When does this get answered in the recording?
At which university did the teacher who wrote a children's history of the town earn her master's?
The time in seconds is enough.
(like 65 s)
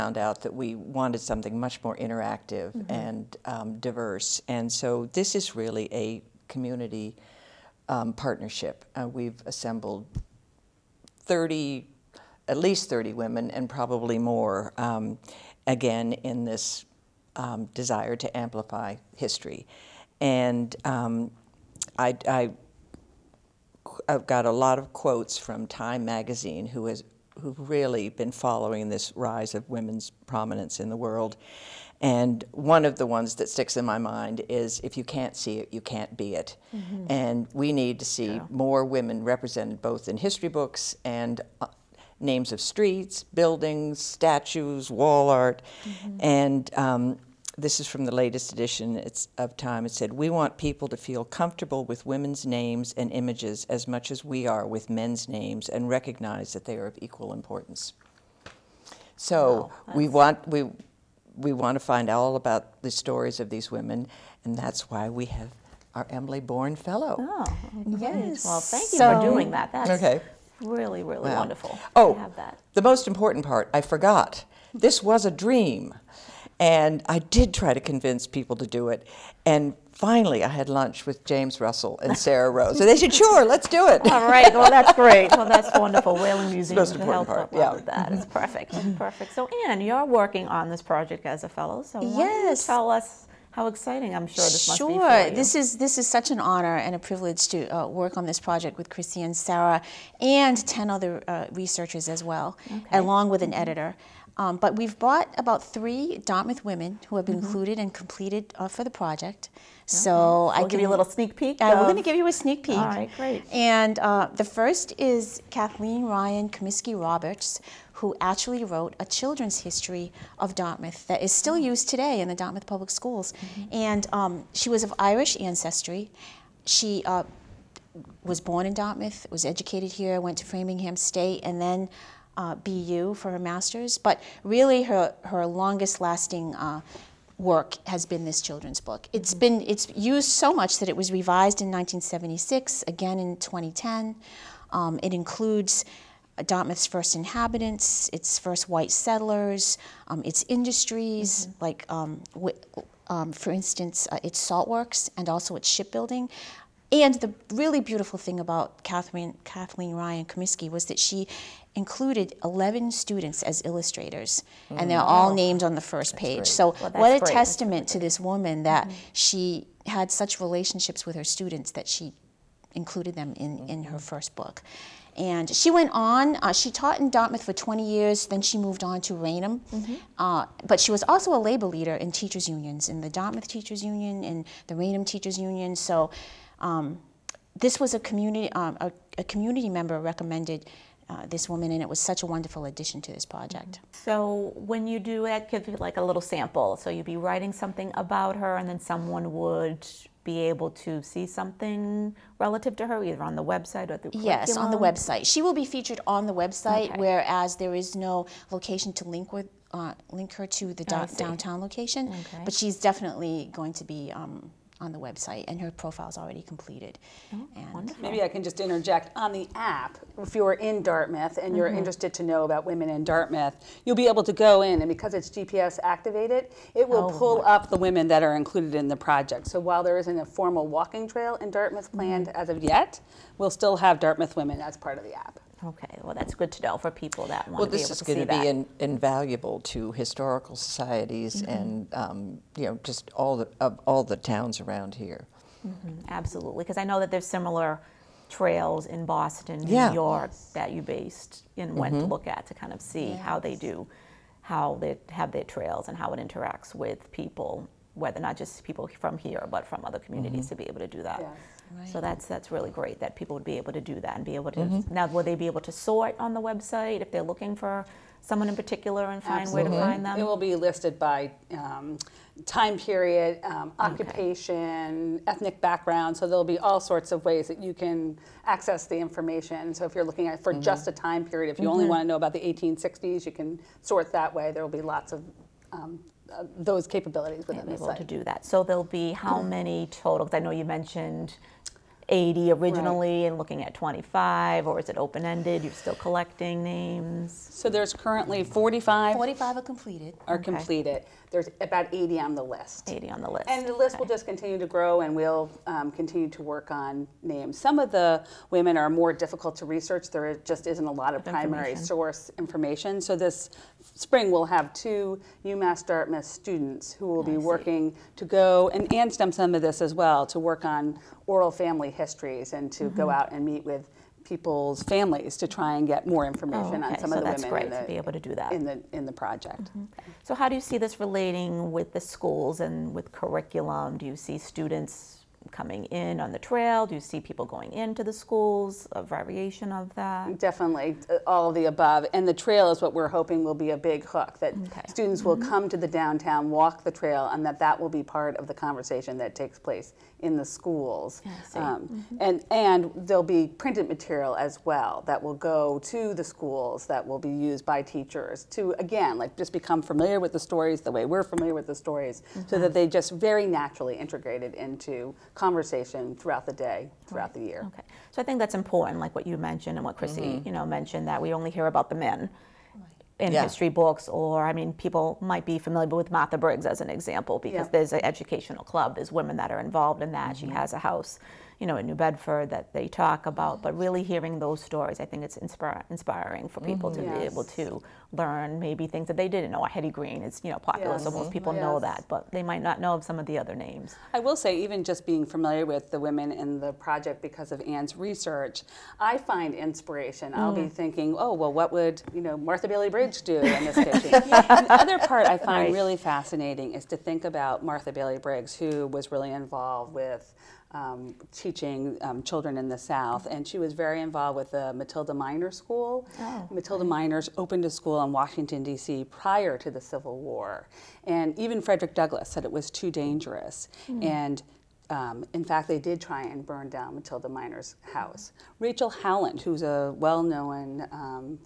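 132 s.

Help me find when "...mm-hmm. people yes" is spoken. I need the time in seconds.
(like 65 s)
391 s.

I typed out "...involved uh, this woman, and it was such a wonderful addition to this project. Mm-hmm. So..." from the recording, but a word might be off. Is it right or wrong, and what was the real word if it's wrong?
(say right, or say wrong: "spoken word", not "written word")
wrong: "recommended", not "involved".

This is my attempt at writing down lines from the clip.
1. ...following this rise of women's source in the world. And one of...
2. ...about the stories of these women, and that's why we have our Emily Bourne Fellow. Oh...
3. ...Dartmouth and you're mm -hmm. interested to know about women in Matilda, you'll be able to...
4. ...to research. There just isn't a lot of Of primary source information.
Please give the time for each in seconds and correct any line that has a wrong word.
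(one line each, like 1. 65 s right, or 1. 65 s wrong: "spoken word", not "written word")
1. 28 s wrong: "prominence", not "source"
2. 62 s right
3. 220 s wrong: "Dartmouth", not "Matilda"
4. 309 s right.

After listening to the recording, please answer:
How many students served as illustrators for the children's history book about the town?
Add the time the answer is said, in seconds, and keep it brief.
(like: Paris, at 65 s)
11, at 162 s.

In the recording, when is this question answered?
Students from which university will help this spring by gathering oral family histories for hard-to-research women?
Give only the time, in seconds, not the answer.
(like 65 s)
315 s.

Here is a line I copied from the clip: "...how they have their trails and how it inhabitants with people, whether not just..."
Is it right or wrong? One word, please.
wrong.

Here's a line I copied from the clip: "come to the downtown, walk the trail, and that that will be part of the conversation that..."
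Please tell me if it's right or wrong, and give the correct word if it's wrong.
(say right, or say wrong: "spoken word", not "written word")
right.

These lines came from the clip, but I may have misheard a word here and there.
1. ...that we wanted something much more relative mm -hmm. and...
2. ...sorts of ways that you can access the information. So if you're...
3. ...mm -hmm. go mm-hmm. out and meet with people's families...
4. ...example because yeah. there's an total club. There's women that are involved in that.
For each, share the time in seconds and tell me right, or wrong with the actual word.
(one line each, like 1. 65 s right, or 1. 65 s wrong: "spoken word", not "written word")
1. 0 s wrong: "interactive", not "relative"
2. 276 s right
3. 322 s right
4. 376 s wrong: "educational", not "total".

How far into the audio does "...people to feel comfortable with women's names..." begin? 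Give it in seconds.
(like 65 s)
50 s.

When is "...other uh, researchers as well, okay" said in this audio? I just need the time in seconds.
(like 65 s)
100 s.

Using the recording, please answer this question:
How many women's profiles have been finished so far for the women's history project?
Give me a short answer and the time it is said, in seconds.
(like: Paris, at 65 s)
45, at 299 s.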